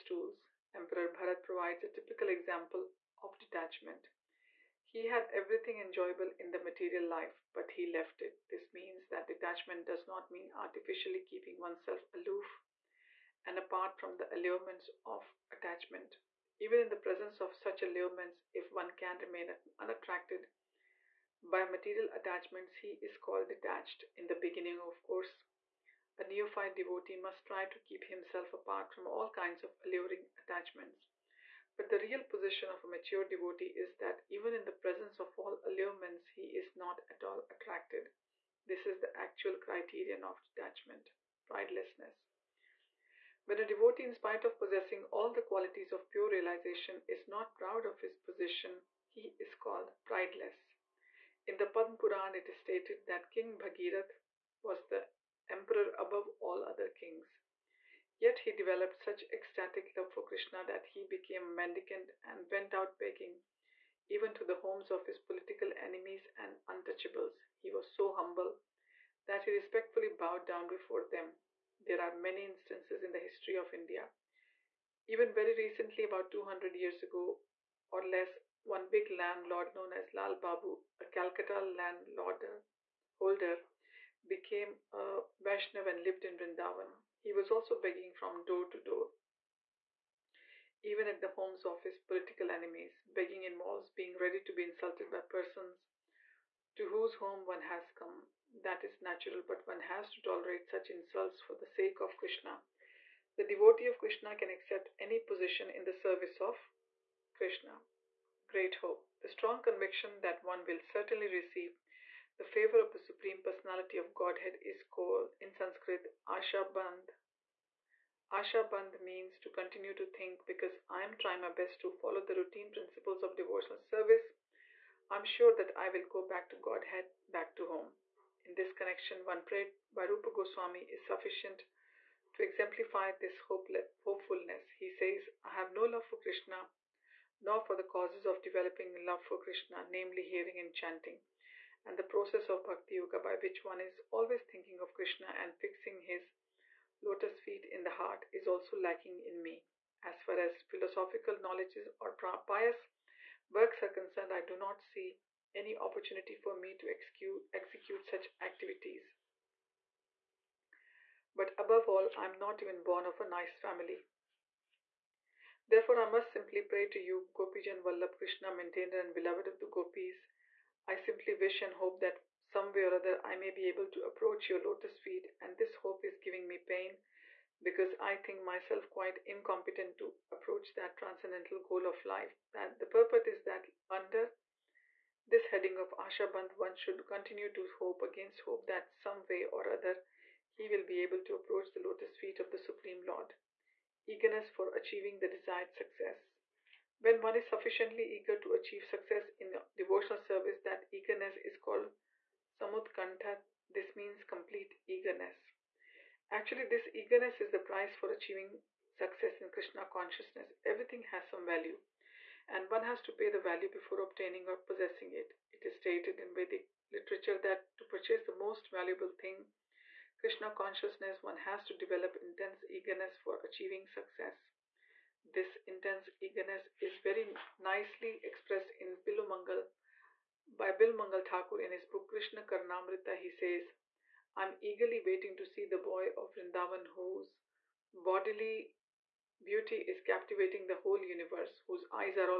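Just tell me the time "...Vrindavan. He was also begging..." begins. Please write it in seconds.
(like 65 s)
86 s.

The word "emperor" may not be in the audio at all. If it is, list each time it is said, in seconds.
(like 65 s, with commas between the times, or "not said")
0 s, 55 s.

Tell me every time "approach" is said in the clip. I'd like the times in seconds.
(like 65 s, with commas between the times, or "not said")
174 s, 180 s, 191 s.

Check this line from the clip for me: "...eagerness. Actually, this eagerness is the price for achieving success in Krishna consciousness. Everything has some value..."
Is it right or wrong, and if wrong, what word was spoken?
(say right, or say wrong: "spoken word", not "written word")
right.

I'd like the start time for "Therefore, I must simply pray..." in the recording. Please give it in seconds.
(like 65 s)
165 s.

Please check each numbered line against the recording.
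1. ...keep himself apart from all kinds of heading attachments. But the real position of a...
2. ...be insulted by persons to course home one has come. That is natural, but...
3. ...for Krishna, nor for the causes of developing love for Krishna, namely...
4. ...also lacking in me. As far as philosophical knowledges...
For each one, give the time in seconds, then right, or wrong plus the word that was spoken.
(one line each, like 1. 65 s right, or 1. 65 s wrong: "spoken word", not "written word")
1. 27 s wrong: "alluring", not "heading"
2. 94 s wrong: "whose", not "course"
3. 136 s right
4. 148 s right.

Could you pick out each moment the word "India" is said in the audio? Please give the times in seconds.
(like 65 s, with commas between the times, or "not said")
73 s.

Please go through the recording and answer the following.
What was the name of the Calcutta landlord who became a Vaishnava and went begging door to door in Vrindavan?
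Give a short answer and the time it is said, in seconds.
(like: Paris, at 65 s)
Lal Babu, at 80 s.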